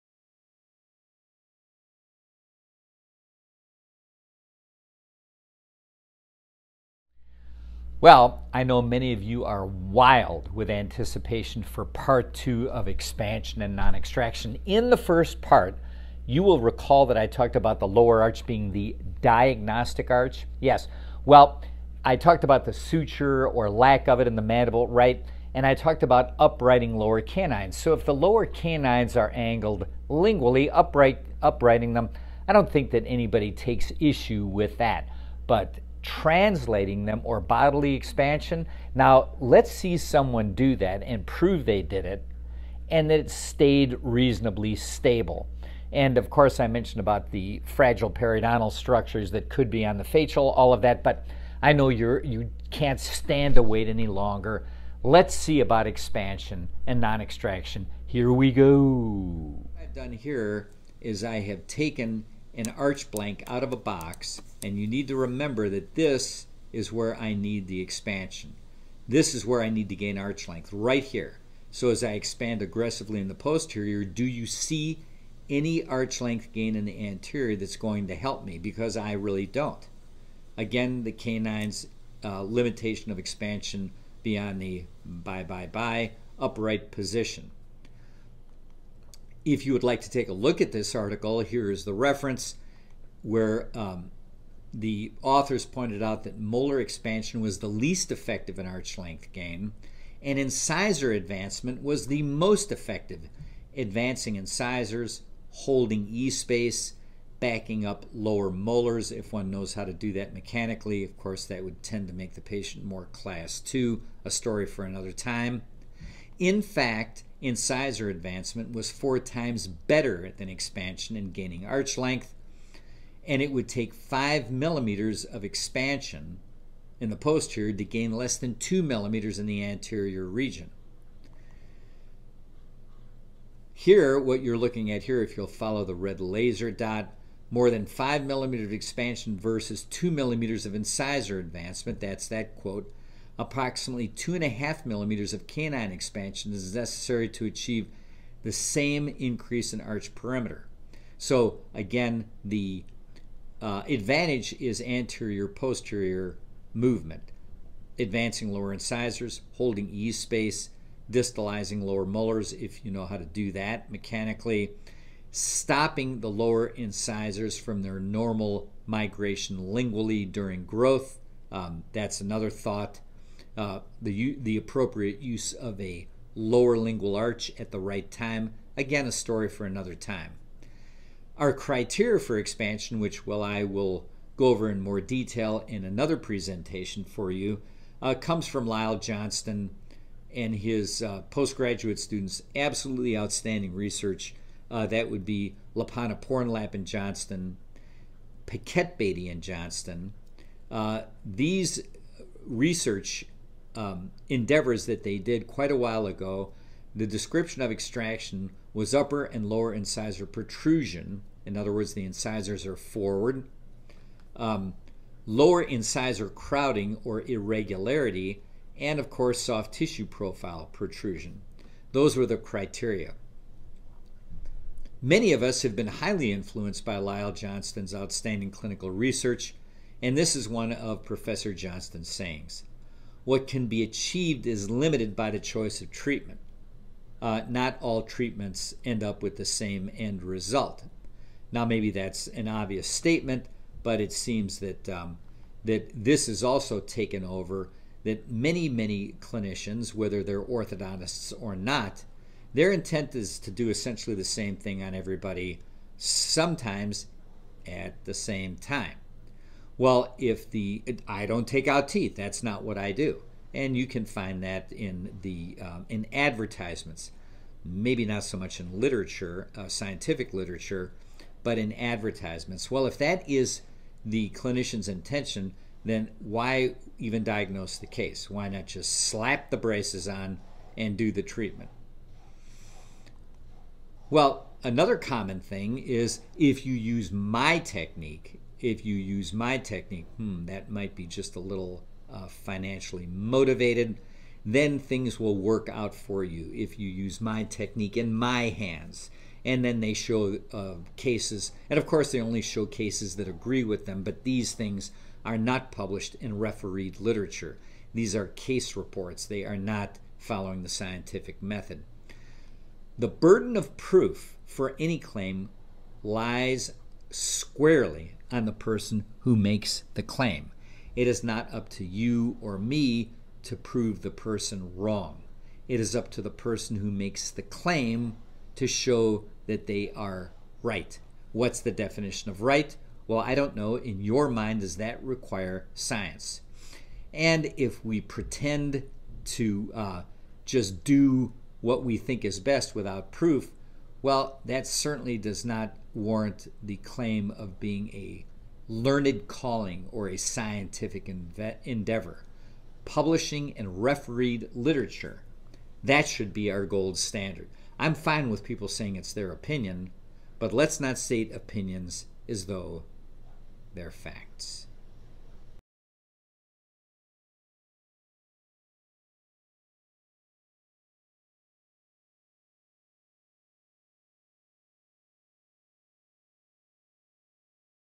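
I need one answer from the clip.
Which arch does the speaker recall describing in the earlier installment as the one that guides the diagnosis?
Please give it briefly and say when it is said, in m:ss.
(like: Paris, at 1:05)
lower arch, at 0:17.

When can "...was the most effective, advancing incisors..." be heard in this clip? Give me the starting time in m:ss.
1:41.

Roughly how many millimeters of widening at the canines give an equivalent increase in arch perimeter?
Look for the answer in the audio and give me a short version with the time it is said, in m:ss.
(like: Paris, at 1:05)
2.5, at 2:24.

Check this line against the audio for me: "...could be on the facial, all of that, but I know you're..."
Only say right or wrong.
right.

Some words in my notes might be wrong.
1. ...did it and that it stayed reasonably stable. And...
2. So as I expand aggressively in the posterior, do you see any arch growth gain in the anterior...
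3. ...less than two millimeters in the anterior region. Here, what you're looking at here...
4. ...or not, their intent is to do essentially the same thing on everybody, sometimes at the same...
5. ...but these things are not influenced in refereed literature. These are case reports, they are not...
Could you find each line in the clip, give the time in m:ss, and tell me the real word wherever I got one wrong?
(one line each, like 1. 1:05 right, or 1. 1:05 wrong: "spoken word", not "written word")
1. 0:41 right
2. 1:11 wrong: "length", not "growth"
3. 2:08 right
4. 4:11 right
5. 5:04 wrong: "published", not "influenced".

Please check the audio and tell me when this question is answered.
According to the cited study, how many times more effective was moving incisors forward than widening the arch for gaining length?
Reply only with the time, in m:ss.
1:58.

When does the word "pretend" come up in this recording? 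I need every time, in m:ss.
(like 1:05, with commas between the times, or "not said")
5:38.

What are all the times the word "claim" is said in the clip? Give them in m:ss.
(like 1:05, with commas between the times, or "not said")
5:14, 5:20, 5:27, 5:46.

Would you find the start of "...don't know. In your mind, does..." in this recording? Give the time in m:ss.
5:33.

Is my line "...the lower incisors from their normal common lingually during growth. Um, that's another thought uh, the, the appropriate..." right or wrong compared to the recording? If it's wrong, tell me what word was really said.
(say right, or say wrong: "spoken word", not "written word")
wrong: "migration", not "common".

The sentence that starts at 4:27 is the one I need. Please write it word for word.
Maybe not so much in literature, uh, scientific literature, but in advertisements.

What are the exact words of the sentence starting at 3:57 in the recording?
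Uh, not all treatments end up with the same end result.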